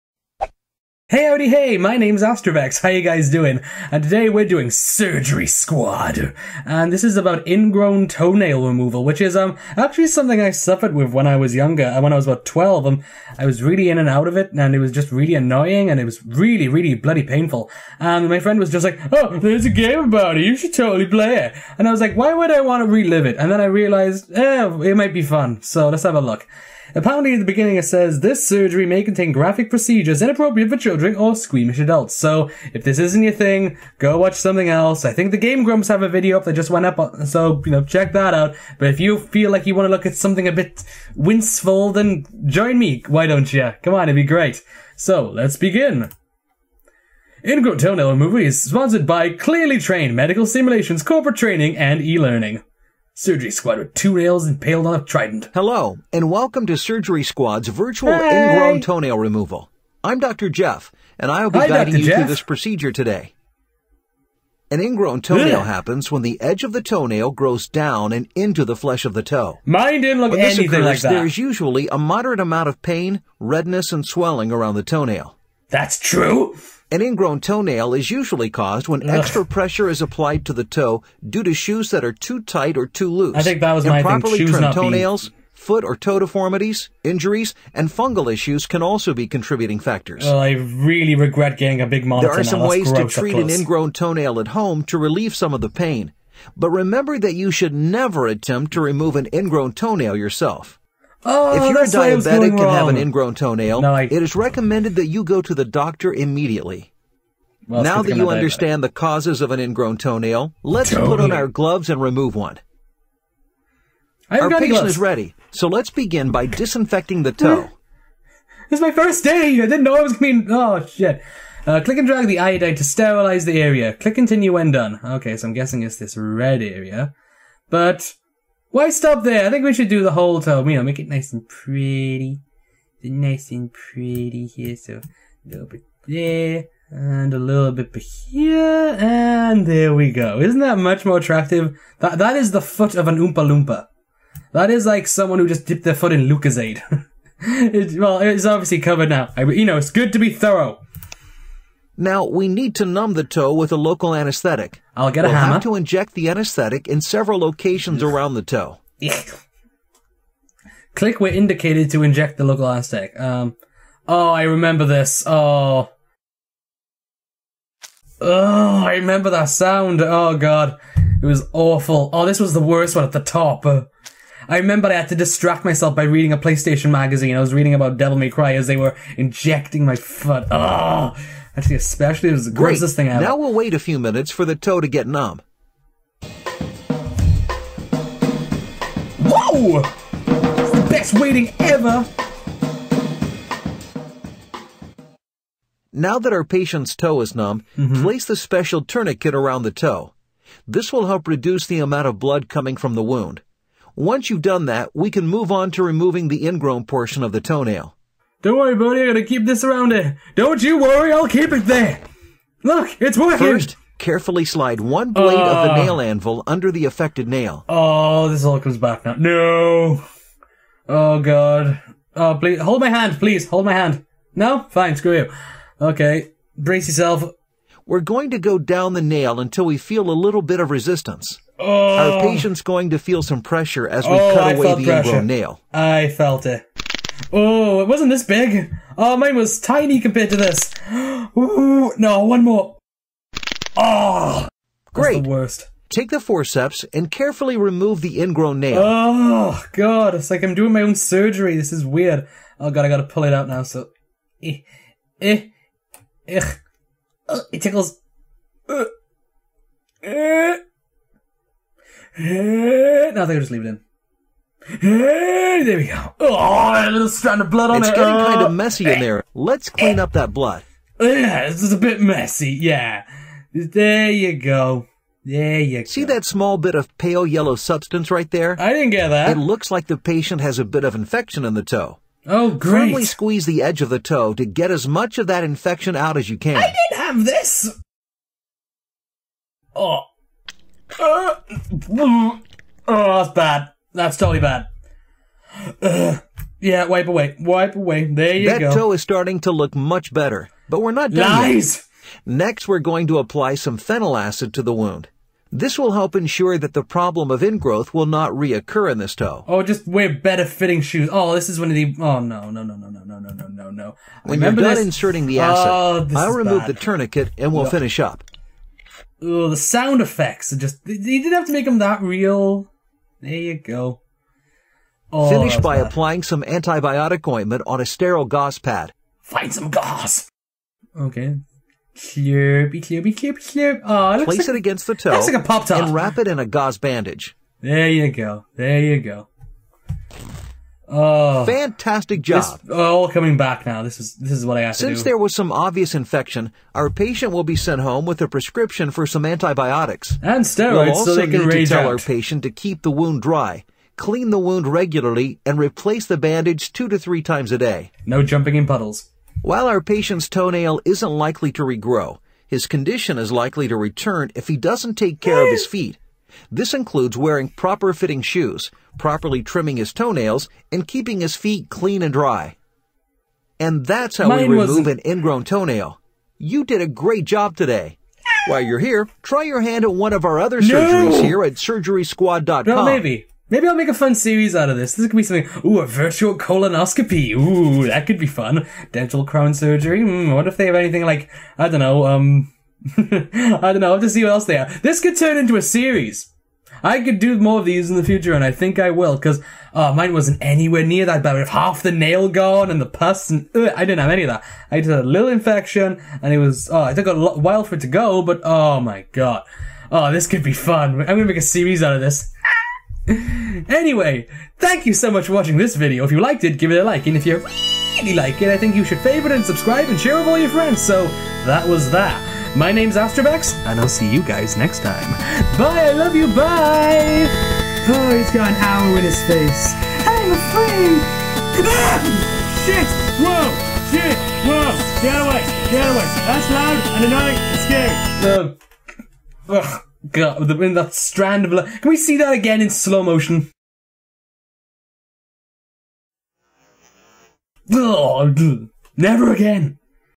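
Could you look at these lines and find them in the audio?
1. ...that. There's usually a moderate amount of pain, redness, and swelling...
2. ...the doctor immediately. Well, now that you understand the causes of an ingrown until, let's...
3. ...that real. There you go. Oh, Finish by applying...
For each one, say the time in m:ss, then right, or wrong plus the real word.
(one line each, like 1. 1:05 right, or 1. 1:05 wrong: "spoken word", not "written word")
1. 1:11 right
2. 1:45 wrong: "toenail", not "until"
3. 5:21 right.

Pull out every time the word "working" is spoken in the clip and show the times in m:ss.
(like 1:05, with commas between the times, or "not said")
3:33.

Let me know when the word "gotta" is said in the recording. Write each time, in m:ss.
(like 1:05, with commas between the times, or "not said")
3:29, 4:12.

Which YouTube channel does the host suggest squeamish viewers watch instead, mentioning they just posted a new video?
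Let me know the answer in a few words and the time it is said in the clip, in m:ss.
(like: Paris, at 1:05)
Game Grumps, at 0:35.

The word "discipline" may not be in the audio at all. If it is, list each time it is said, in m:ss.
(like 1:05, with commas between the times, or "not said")
not said.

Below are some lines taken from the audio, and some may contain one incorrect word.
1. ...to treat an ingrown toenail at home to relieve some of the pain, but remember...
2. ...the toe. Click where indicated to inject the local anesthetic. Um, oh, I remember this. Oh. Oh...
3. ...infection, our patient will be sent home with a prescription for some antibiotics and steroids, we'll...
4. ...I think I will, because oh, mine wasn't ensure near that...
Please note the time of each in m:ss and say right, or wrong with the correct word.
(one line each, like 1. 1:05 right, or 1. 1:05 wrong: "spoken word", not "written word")
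1. 1:32 right
2. 2:38 right
3. 5:45 right
4. 6:38 wrong: "anywhere", not "ensure".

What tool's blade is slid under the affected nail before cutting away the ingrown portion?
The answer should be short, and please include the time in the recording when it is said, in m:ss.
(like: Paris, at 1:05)
nail anvil, at 3:35.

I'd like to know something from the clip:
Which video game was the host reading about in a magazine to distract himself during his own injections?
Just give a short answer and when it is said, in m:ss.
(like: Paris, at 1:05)
Devil May Cry, at 2:57.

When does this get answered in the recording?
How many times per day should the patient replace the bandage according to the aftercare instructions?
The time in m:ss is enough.
5:56.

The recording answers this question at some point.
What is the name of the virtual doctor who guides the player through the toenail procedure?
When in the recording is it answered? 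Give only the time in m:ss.
1:00.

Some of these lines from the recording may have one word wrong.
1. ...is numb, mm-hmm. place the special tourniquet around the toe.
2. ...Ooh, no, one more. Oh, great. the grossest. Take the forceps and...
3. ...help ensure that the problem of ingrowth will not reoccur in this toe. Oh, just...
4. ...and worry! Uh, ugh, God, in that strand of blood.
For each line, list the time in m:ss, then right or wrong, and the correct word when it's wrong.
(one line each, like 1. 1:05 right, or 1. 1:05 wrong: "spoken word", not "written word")
1. 3:17 right
2. 4:01 wrong: "worst", not "grossest"
3. 5:05 right
4. 7:18 wrong: "scary", not "worry".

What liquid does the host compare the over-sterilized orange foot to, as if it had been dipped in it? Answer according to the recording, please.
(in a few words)
Lucozade.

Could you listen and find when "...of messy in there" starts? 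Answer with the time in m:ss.
4:28.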